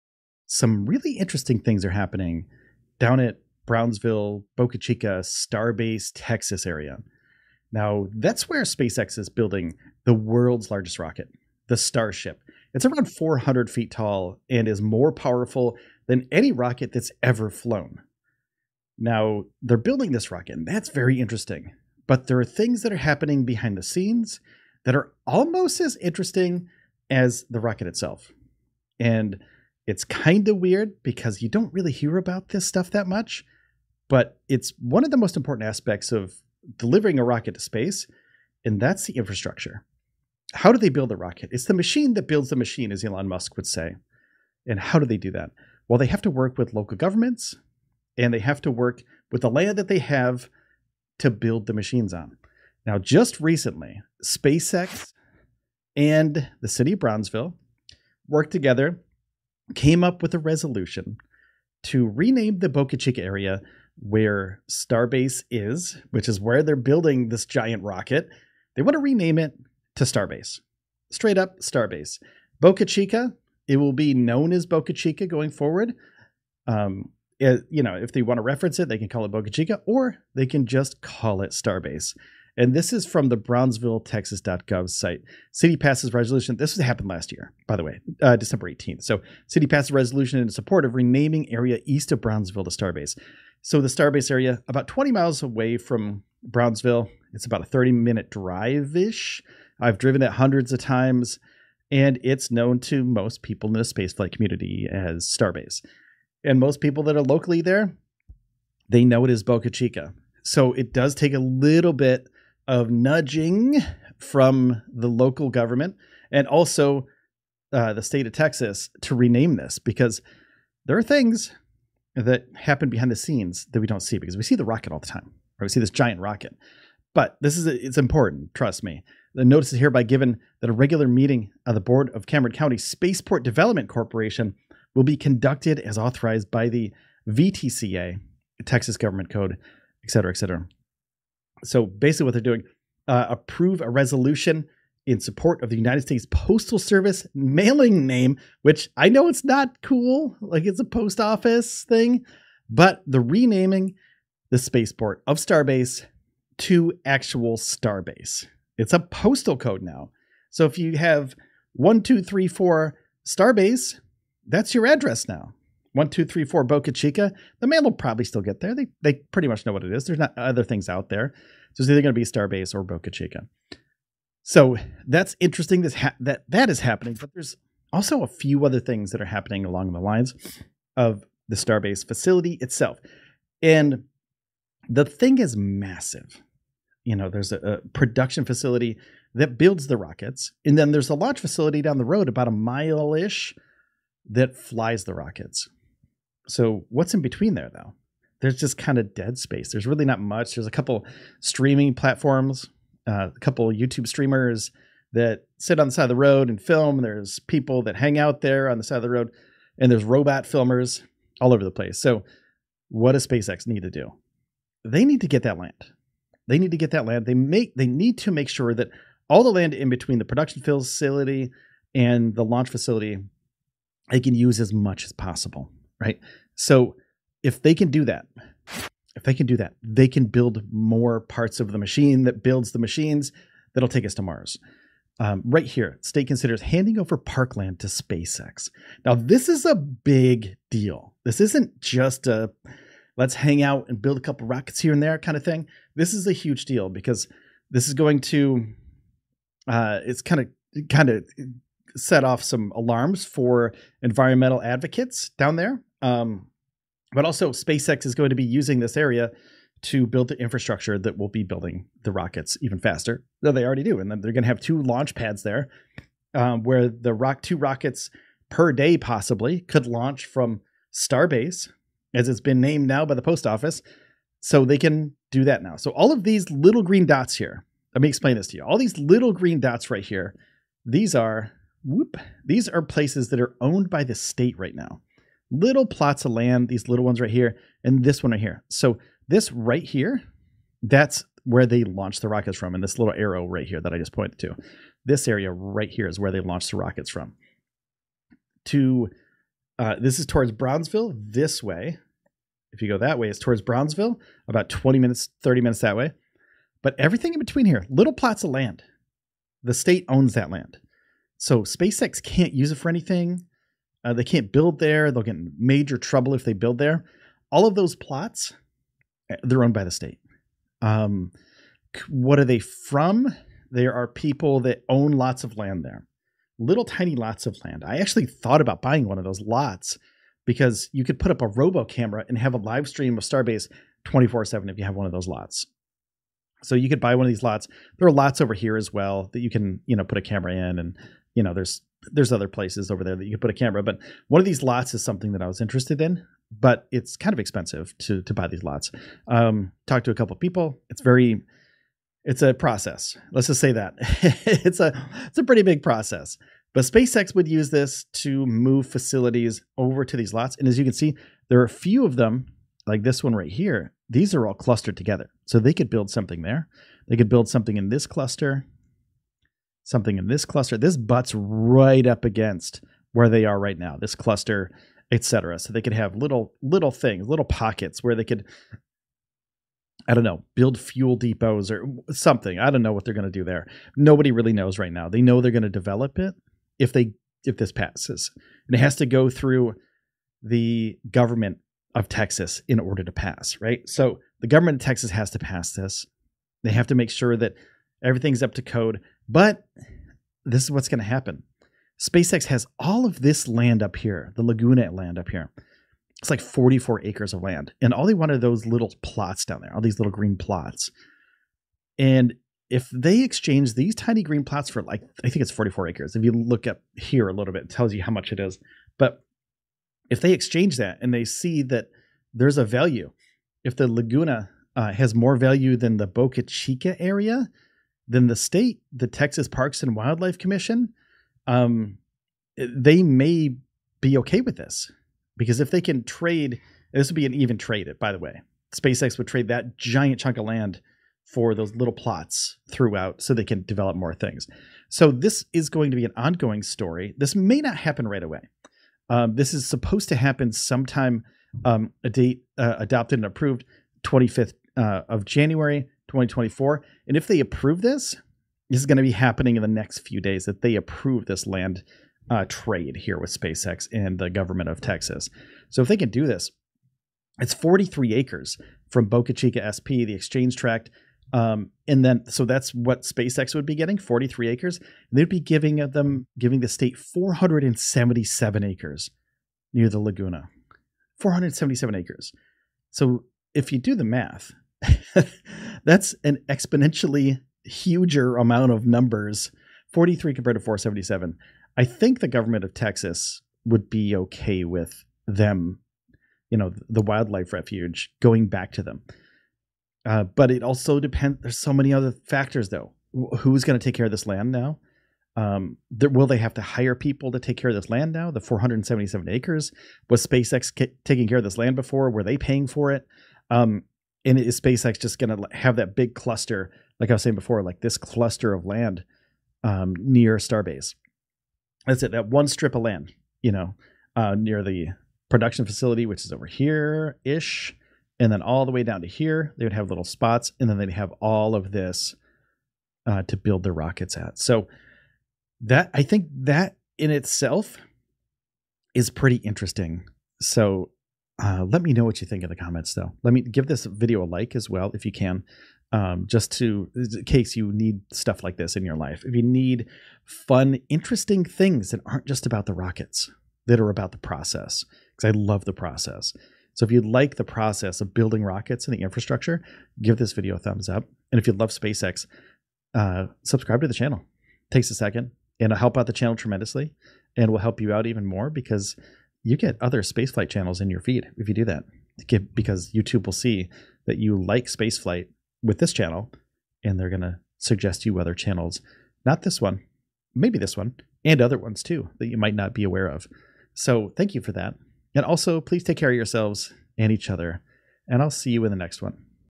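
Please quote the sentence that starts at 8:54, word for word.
So that I think that in itself is pretty interesting.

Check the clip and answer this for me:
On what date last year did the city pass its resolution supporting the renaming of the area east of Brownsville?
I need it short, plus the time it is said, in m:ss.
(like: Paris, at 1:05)
December 18th, at 1:28.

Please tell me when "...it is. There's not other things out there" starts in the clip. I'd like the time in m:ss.
2:49.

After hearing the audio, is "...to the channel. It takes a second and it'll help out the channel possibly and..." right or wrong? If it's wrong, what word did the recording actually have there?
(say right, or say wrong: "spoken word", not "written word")
wrong: "tremendously", not "possibly".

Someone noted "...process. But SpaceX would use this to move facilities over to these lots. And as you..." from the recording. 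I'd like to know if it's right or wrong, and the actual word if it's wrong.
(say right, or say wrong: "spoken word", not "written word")
right.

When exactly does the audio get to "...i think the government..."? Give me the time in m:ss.
8:11.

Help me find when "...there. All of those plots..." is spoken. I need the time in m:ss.
5:16.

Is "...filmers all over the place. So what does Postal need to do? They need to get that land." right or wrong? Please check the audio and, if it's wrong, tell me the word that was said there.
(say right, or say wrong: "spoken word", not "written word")
wrong: "SpaceX", not "Postal".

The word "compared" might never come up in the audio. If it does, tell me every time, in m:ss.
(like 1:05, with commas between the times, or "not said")
8:10.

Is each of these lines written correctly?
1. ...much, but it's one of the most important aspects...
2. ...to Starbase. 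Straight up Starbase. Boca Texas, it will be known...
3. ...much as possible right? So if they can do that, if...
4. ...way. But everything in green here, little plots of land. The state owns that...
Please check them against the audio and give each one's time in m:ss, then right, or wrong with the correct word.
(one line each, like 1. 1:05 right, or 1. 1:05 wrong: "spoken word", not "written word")
1. 0:33 right
2. 1:09 wrong: "Chica", not "Texas"
3. 3:44 right
4. 5:05 wrong: "between", not "green".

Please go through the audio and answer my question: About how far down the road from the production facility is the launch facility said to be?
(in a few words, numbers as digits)
about a mile.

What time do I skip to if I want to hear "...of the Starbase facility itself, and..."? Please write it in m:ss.
3:00.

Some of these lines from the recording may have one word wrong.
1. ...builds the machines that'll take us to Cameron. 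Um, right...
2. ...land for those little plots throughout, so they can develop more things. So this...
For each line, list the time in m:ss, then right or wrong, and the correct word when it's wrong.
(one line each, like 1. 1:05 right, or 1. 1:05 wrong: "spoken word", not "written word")
1. 3:52 wrong: "Mars", not "Cameron"
2. 7:20 right.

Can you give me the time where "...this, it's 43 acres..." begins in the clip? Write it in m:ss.
7:46.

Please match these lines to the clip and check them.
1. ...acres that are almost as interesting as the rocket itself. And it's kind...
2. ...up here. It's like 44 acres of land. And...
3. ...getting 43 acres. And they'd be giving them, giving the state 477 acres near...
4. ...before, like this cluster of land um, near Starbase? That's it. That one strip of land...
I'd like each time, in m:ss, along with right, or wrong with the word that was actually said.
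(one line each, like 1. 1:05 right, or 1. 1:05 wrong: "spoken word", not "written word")
1. 0:23 wrong: "scenes", not "acres"
2. 6:45 right
3. 7:53 right
4. 8:37 right.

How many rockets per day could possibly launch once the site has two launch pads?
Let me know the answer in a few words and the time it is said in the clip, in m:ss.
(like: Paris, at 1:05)
2, at 4:27.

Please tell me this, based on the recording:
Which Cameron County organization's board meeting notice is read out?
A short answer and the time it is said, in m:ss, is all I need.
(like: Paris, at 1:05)
Cameron County Spaceport Development Corporation, at 2:12.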